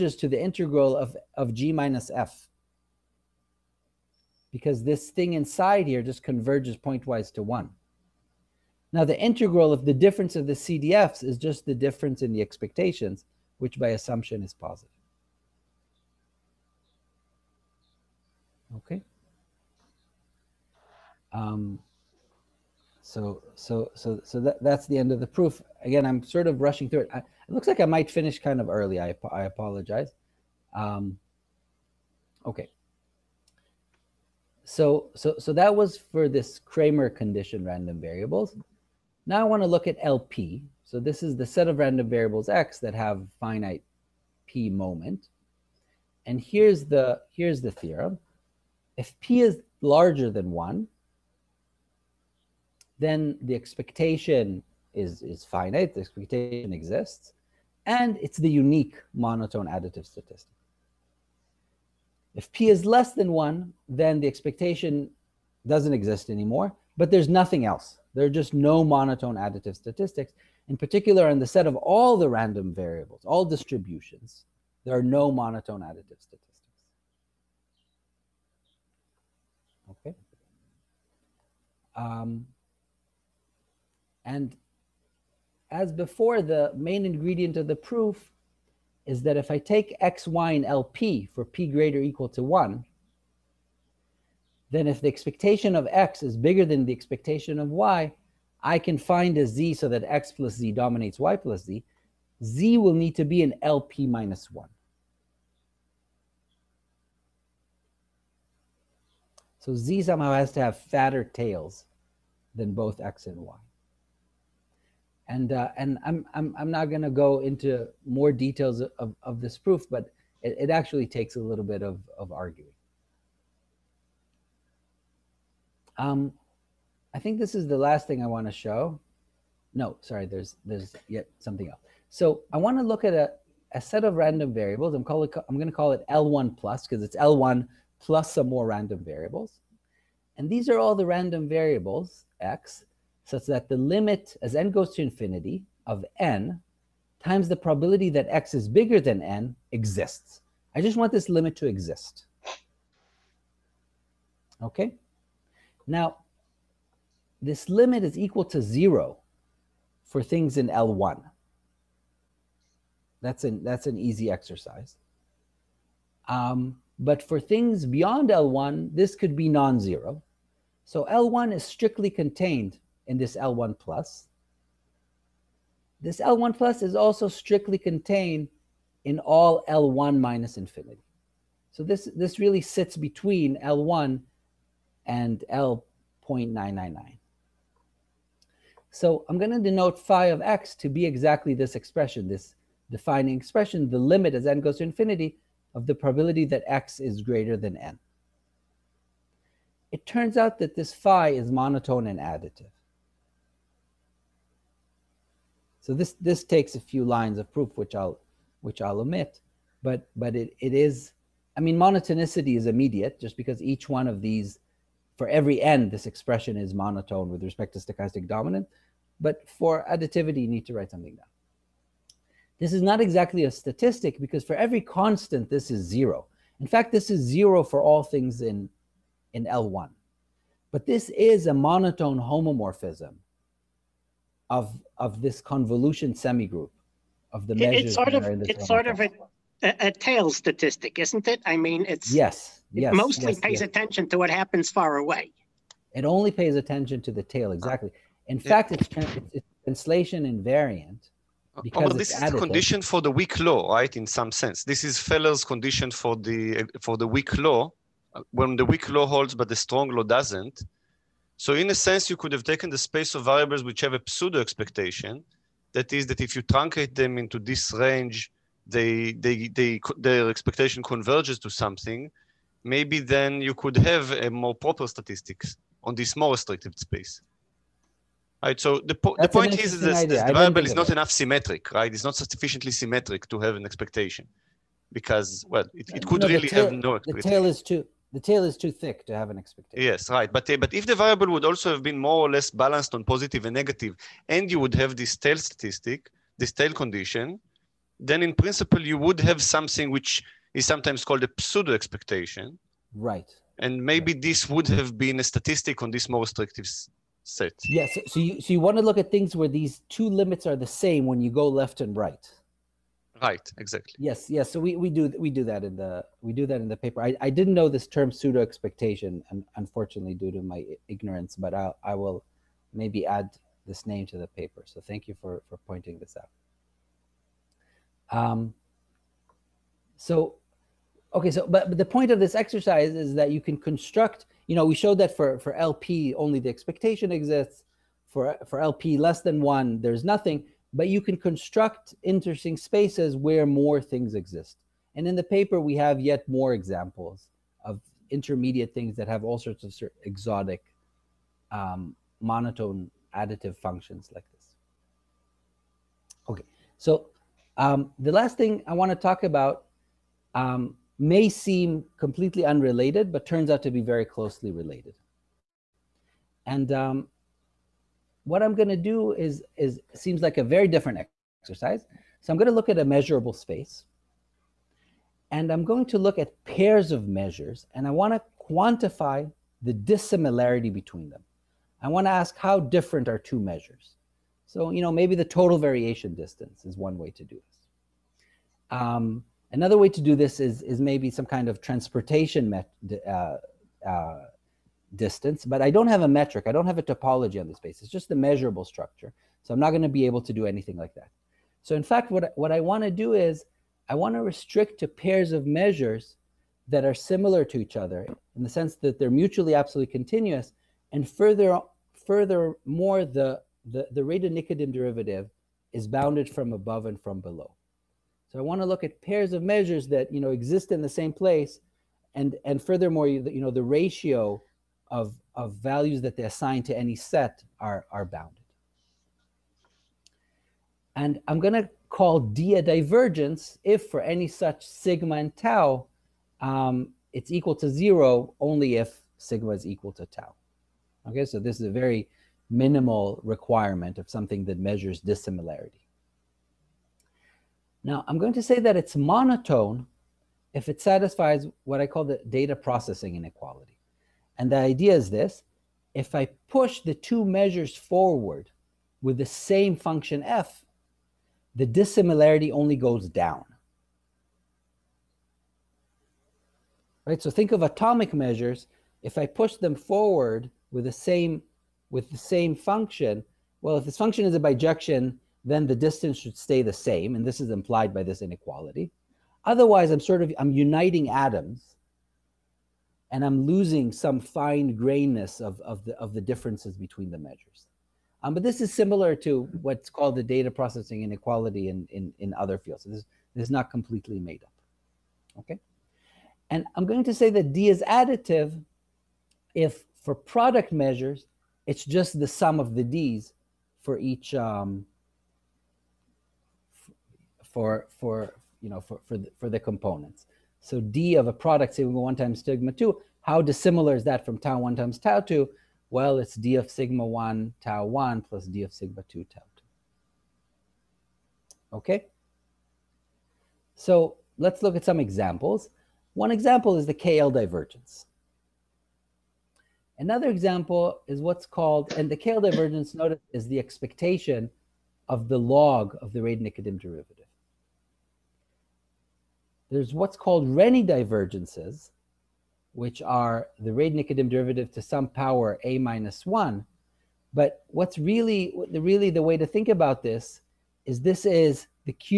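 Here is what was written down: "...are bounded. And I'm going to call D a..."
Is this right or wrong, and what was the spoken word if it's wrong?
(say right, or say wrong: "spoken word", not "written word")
right.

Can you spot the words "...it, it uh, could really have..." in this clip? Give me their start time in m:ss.
4:45.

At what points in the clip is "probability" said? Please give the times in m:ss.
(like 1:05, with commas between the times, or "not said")
2:27, 3:15.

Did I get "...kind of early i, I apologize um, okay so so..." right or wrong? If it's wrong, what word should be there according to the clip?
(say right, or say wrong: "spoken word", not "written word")
right.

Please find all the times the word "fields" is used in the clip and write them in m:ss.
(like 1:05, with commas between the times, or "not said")
8:12.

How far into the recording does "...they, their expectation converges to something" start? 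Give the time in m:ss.
4:29.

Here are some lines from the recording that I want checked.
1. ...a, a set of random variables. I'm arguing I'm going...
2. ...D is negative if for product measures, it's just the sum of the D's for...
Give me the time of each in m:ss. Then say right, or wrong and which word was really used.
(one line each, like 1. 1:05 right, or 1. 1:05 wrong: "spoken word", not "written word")
1. 2:13 wrong: "calling", not "arguing"
2. 8:17 wrong: "additive", not "negative".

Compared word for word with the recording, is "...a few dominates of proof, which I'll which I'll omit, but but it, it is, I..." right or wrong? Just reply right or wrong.
wrong.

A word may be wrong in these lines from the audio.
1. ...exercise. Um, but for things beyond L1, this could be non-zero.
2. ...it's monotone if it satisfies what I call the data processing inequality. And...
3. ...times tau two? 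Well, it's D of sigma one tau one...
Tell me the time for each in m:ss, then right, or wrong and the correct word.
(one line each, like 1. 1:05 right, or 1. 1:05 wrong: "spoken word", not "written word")
1. 2:44 right
2. 7:28 right
3. 8:34 right.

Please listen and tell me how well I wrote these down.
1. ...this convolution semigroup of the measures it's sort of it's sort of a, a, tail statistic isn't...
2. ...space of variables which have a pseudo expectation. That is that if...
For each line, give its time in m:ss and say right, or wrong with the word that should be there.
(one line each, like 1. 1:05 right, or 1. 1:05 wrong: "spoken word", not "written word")
1. 3:55 right
2. 4:22 right.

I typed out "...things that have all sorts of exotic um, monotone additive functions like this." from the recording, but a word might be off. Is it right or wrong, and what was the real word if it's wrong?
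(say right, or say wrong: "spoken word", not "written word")
right.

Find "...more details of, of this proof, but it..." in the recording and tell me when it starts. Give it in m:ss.
1:58.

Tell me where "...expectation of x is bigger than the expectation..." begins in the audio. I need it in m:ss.
1:35.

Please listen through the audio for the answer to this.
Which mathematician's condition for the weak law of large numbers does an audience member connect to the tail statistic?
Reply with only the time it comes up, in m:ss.
4:15.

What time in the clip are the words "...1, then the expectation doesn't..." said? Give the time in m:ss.
1:03.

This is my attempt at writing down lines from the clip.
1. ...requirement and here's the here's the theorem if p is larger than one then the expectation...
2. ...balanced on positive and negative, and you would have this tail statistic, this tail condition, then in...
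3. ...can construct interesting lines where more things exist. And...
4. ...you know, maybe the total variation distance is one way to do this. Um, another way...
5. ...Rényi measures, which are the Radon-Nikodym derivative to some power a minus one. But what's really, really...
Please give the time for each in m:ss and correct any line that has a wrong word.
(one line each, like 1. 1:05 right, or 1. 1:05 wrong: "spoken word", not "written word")
1. 0:44 wrong: "moment", not "requirement"
2. 4:52 right
3. 5:41 wrong: "spaces", not "lines"
4. 6:24 right
5. 9:00 wrong: "divergences", not "measures".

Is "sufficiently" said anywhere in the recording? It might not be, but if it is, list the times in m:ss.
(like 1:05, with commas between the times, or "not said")
4:42.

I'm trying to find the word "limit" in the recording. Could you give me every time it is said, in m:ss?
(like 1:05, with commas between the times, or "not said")
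2:23, 2:31, 2:37, 3:13, 5:10.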